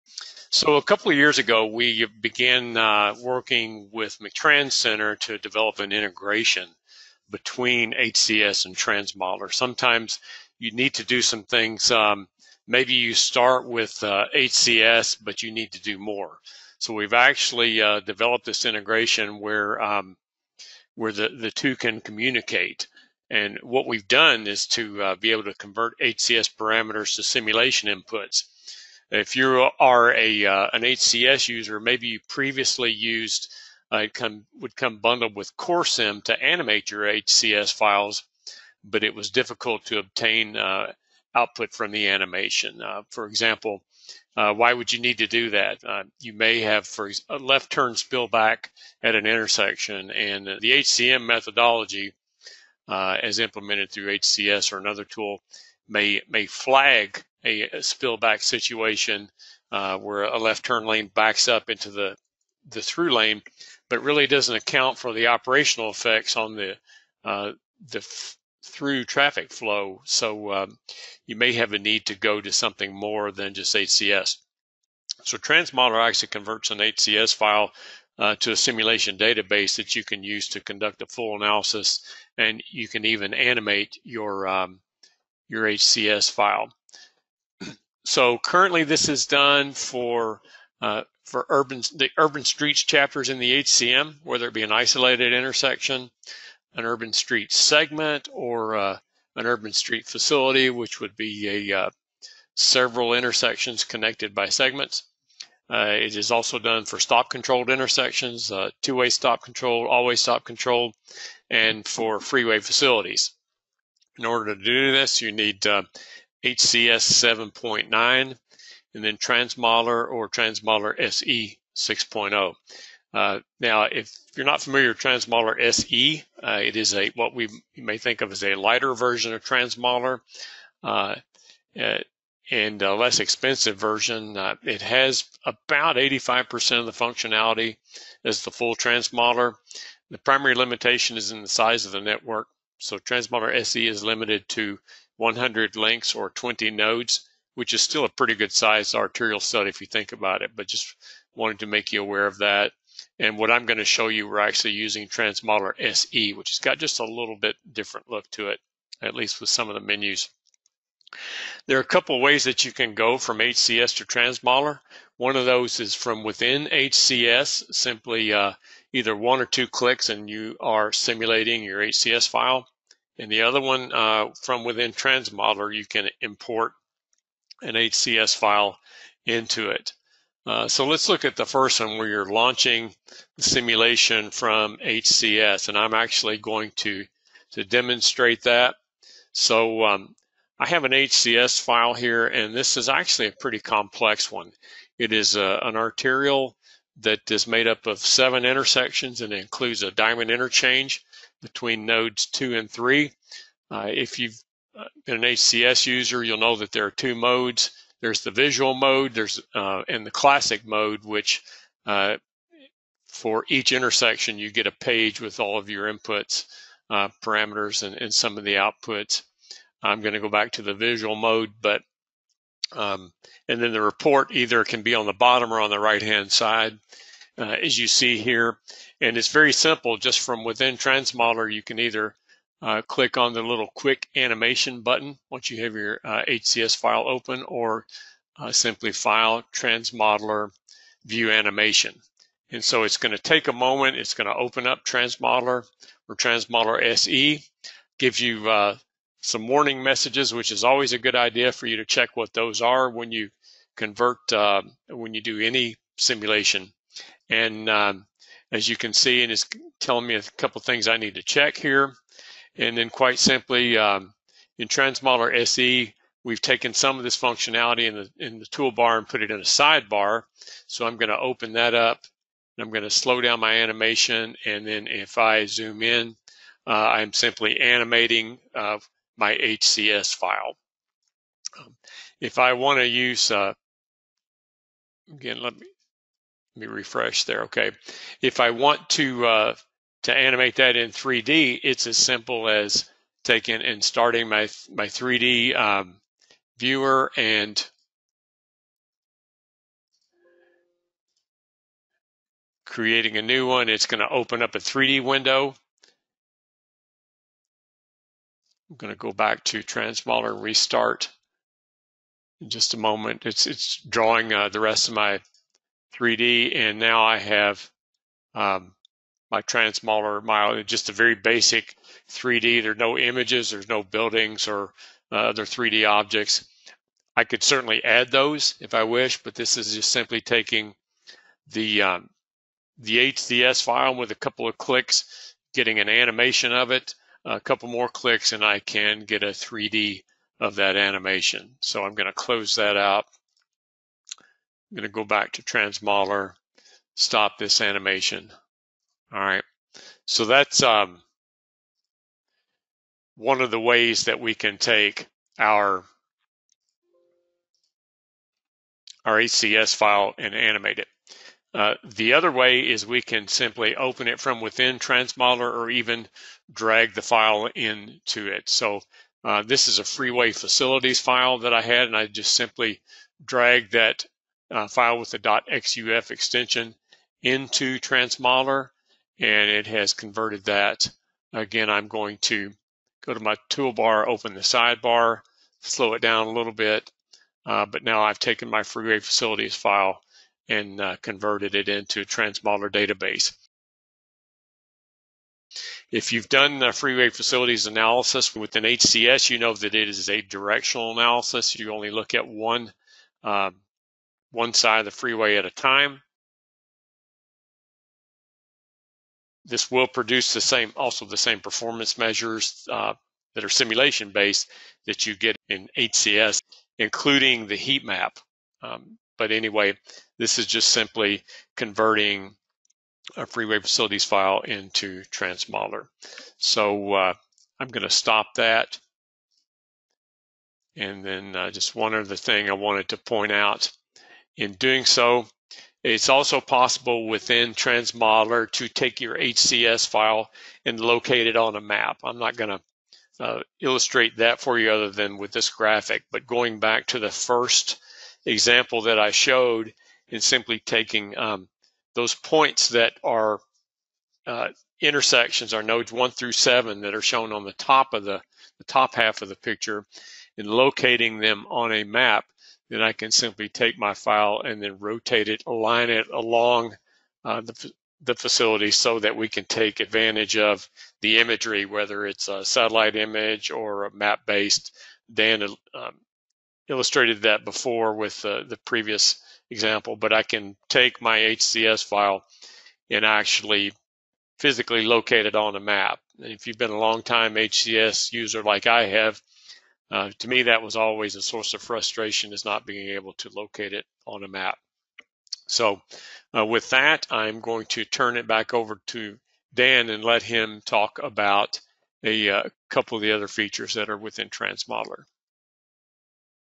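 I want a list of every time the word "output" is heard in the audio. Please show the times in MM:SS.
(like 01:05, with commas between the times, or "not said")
00:41, 03:38.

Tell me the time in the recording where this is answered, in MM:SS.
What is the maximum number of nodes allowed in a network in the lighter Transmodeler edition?
02:26.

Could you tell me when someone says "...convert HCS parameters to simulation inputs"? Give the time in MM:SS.
00:25.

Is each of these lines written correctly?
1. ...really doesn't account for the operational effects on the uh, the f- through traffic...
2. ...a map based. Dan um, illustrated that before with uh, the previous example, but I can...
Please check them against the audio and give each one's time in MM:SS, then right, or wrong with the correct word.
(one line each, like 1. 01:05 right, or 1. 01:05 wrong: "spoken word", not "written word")
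1. 01:04 right
2. 07:53 right.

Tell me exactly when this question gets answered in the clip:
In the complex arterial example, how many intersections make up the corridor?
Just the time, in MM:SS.
03:17.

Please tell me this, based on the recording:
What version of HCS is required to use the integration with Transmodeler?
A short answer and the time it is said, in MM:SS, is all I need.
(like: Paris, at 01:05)
7.9, at 01:56.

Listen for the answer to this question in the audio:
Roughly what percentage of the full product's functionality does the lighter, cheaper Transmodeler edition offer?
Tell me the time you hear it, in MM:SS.
02:15.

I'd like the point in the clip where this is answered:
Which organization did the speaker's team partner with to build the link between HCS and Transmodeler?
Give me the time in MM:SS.
00:04.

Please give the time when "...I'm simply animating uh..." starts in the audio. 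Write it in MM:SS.
04:36.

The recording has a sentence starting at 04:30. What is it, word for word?
So I'm gonna open that up and I'm gonna slow down my animation.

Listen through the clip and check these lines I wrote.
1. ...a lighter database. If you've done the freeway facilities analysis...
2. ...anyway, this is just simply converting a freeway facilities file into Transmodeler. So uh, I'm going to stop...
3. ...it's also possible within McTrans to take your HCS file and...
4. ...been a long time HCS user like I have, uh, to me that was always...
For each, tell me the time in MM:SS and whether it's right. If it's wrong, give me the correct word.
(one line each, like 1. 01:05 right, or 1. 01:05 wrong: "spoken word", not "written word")
1. 06:32 wrong: "transmodeler", not "lighter"
2. 06:59 right
3. 07:15 wrong: "Transmodeler", not "McTrans"
4. 08:06 right.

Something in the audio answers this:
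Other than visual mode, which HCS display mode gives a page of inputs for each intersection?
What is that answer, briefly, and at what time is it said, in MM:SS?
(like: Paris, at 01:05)
classic mode, at 03:30.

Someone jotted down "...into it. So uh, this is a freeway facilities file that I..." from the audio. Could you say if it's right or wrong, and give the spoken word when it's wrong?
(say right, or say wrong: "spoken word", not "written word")
right.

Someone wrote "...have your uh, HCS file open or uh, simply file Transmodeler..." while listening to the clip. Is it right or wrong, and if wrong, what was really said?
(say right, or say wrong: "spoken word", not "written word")
right.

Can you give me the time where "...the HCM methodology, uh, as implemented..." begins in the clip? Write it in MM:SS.
00:50.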